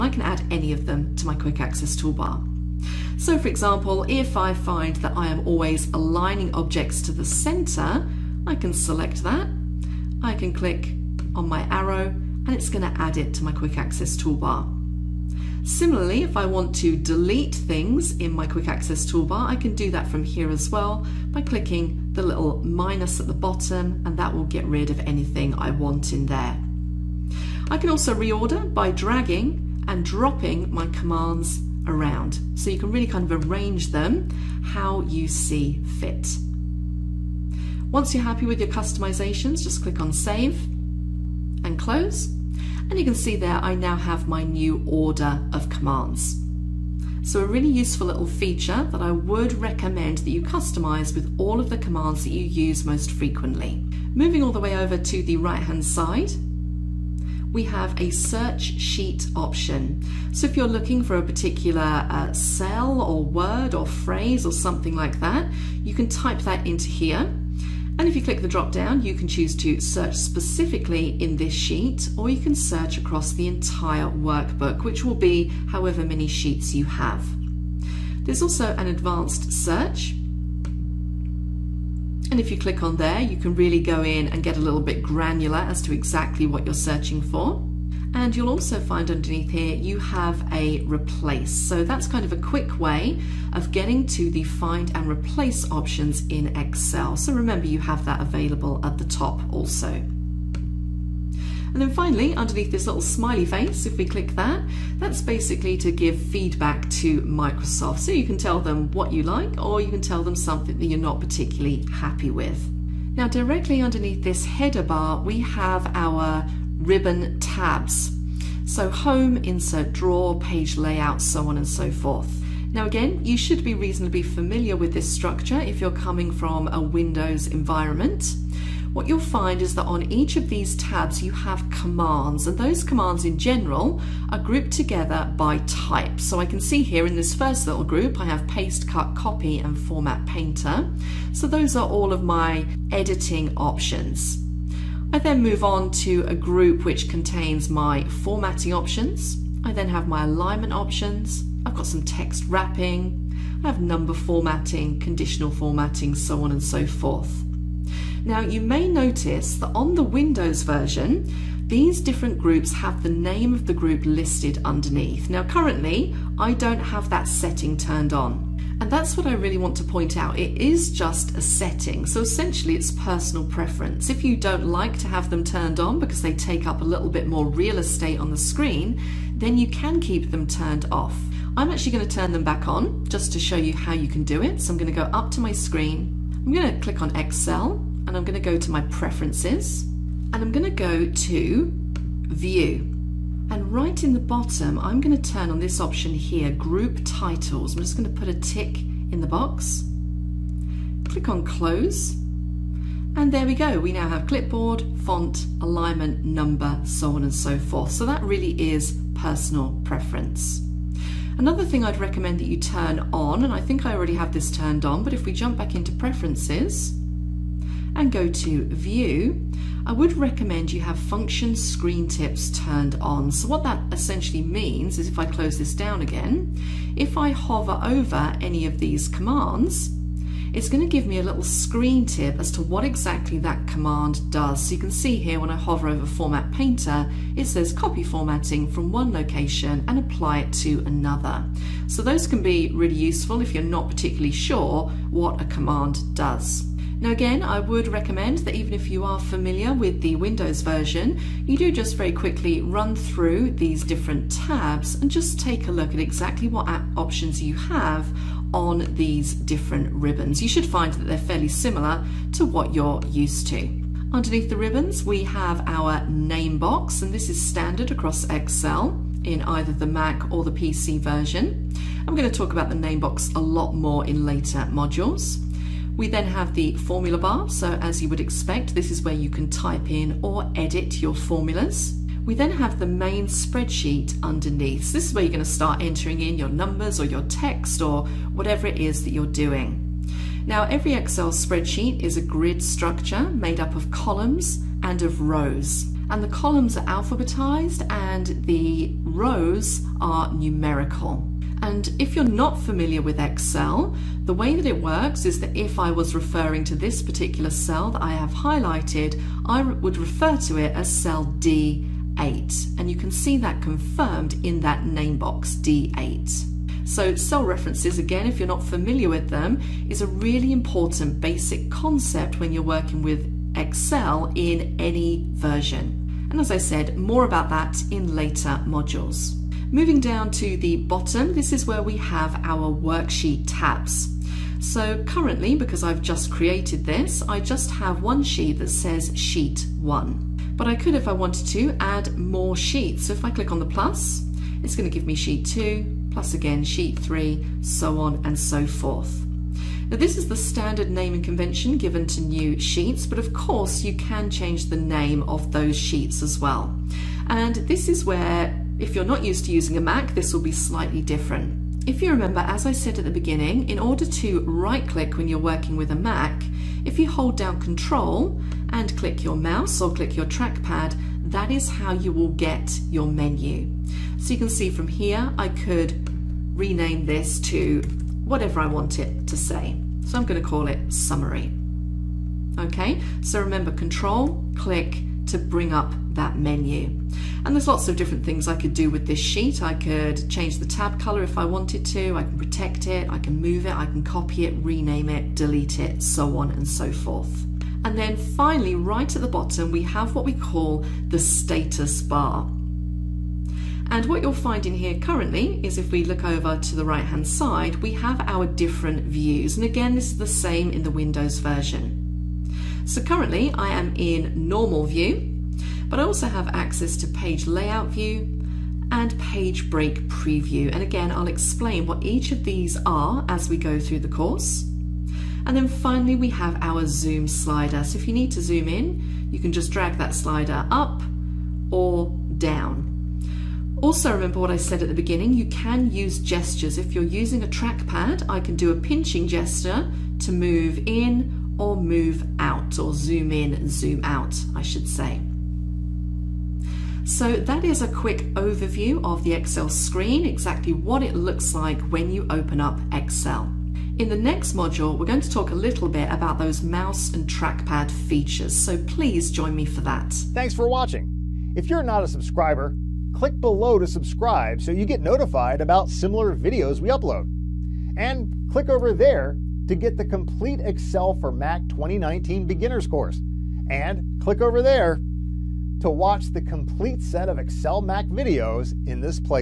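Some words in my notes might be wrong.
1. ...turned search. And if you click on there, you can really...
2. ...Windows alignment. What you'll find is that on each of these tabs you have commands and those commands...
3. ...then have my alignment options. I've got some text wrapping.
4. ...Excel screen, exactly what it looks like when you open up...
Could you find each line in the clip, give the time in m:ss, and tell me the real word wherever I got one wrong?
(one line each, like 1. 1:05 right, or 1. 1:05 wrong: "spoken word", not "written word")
1. 1:18 wrong: "advanced", not "turned"
2. 2:06 wrong: "environment", not "alignment"
3. 2:29 right
4. 7:29 right.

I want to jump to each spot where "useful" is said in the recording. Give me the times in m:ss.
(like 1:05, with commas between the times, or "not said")
0:47, 4:02.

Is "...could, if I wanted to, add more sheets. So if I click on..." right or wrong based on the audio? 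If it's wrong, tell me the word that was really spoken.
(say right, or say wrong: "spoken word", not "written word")
right.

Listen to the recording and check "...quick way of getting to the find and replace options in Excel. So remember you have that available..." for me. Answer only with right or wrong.
right.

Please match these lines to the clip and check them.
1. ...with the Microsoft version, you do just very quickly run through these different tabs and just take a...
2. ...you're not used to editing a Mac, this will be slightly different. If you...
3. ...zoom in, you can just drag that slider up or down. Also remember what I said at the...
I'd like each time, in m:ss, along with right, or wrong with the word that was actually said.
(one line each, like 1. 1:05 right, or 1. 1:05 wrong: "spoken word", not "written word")
1. 4:09 wrong: "Windows", not "Microsoft"
2. 5:58 wrong: "using", not "editing"
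3. 7:08 right.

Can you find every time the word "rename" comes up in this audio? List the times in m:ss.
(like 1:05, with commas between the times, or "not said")
6:16, 6:34.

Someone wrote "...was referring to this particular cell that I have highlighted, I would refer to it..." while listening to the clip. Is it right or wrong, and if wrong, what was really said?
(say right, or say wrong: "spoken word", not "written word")
right.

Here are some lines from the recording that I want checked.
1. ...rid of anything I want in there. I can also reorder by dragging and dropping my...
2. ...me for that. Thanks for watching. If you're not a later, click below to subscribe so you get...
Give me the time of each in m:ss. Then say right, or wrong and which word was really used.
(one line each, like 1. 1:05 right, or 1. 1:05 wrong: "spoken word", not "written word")
1. 0:24 right
2. 7:39 wrong: "subscriber", not "later".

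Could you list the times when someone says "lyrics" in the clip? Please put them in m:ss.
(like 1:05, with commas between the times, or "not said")
not said.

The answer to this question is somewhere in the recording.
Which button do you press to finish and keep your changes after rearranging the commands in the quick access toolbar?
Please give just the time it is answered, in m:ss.
0:40.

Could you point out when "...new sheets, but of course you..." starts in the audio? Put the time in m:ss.
5:52.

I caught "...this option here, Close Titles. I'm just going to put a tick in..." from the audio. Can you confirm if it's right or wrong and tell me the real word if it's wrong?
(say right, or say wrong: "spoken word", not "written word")
wrong: "Group", not "Close".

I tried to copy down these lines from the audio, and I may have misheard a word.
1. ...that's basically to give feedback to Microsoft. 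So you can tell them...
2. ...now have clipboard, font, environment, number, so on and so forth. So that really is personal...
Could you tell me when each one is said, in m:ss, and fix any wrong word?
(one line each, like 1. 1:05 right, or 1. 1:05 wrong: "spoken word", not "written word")
1. 1:44 right
2. 3:23 wrong: "alignment", not "environment".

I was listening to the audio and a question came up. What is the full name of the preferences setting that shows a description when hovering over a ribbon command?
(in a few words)
Function screen tips.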